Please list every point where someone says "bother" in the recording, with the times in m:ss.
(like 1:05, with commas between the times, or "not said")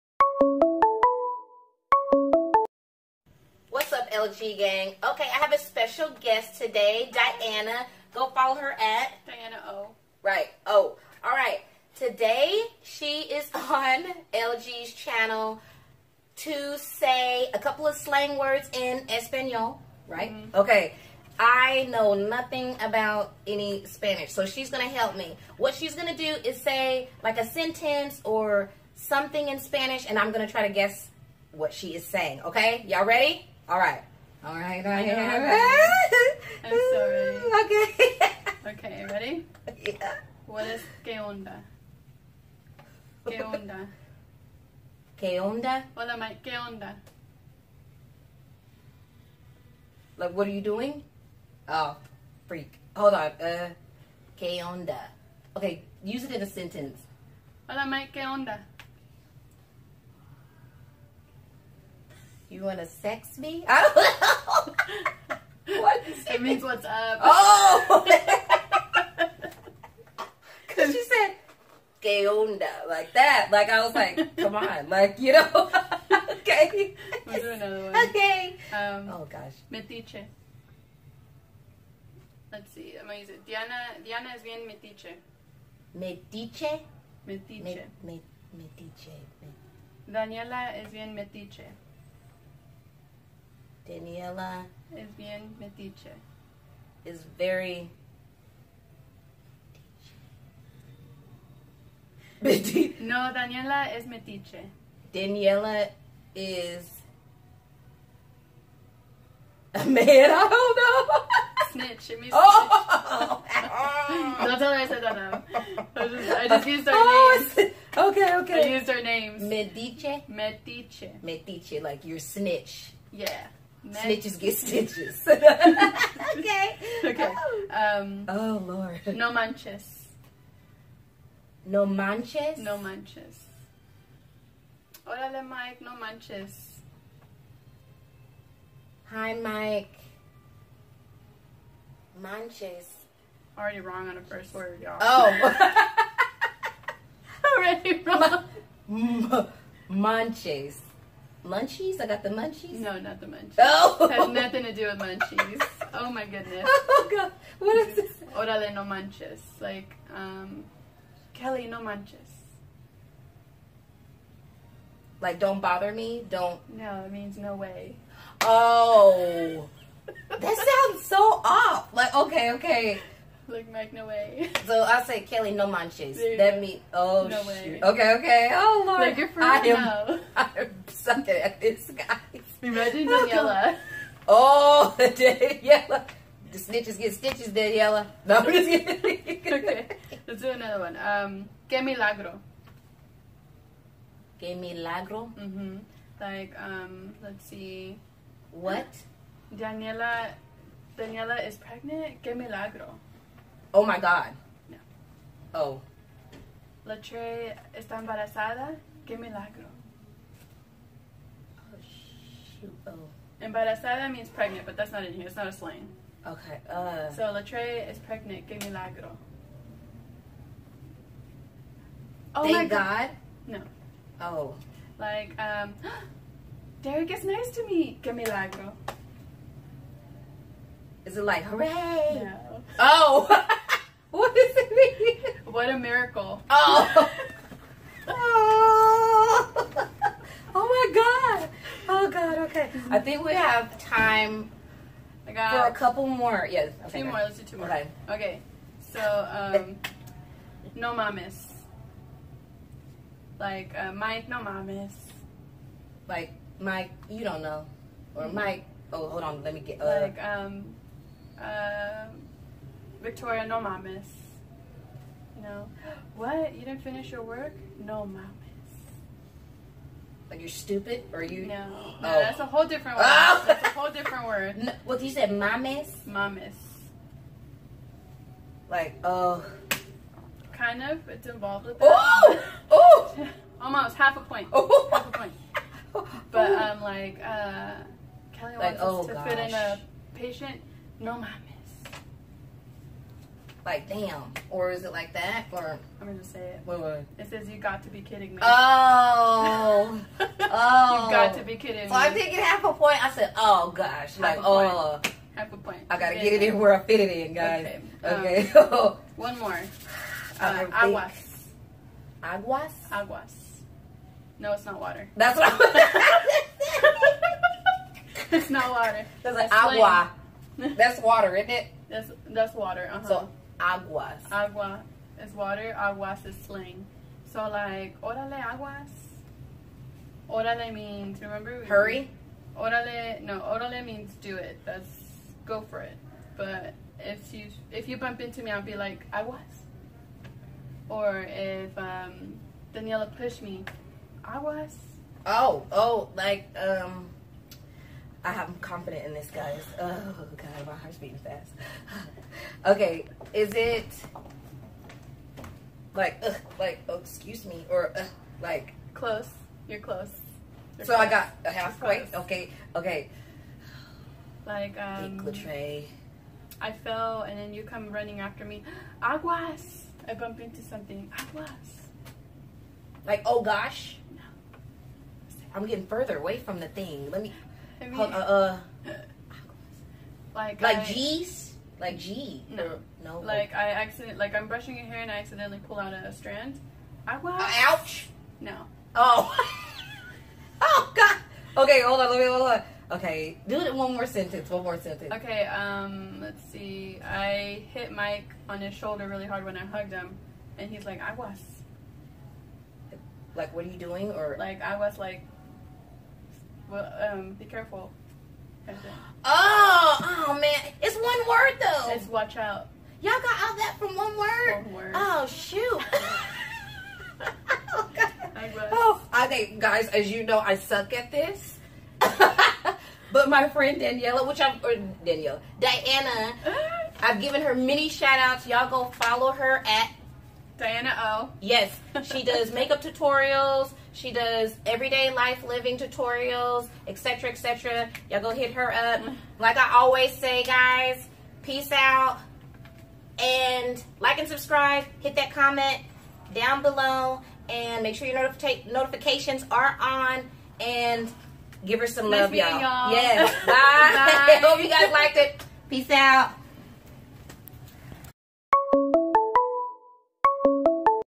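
2:45.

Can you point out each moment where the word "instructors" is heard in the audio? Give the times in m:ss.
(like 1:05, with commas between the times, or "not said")
not said.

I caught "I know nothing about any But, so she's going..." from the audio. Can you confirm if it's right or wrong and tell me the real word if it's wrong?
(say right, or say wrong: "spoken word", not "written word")
wrong: "Spanish", not "But".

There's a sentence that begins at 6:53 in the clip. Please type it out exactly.
Y'all got all that from one word.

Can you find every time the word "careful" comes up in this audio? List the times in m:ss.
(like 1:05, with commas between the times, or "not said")
6:47.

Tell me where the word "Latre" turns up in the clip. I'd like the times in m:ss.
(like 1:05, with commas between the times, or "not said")
3:26, 3:37, 6:05.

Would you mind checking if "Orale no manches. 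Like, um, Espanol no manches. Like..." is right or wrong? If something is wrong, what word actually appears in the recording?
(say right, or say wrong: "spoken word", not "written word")
wrong: "Kelly", not "Espanol".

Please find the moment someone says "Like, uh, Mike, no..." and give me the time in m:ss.
4:13.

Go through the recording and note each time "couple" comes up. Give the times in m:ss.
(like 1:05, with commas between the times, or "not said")
0:17, 4:05.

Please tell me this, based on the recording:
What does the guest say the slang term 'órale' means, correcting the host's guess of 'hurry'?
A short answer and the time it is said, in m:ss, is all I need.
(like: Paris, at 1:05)
go for it, at 5:35.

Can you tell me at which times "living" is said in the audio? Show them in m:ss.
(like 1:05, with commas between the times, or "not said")
7:15.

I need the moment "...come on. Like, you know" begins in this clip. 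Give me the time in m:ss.
1:14.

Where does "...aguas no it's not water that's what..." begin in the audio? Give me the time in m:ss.
5:12.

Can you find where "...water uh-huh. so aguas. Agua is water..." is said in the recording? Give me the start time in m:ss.
5:22.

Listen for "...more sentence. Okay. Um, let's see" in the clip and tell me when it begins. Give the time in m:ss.
6:34.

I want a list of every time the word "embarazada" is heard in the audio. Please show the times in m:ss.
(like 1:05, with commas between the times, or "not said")
3:28, 3:33.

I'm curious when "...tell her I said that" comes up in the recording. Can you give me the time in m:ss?
1:54.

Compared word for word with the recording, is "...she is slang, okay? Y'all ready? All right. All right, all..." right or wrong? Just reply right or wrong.
wrong.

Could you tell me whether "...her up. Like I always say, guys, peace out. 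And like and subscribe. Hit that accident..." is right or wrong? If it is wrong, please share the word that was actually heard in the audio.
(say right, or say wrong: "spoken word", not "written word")
wrong: "comment", not "accident".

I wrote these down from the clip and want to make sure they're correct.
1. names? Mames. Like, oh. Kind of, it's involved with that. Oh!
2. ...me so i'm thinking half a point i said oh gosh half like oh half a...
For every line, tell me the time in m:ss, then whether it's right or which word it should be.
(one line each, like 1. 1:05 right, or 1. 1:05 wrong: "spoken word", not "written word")
1. 4:35 wrong: "mames", not "names"
2. 5:01 right.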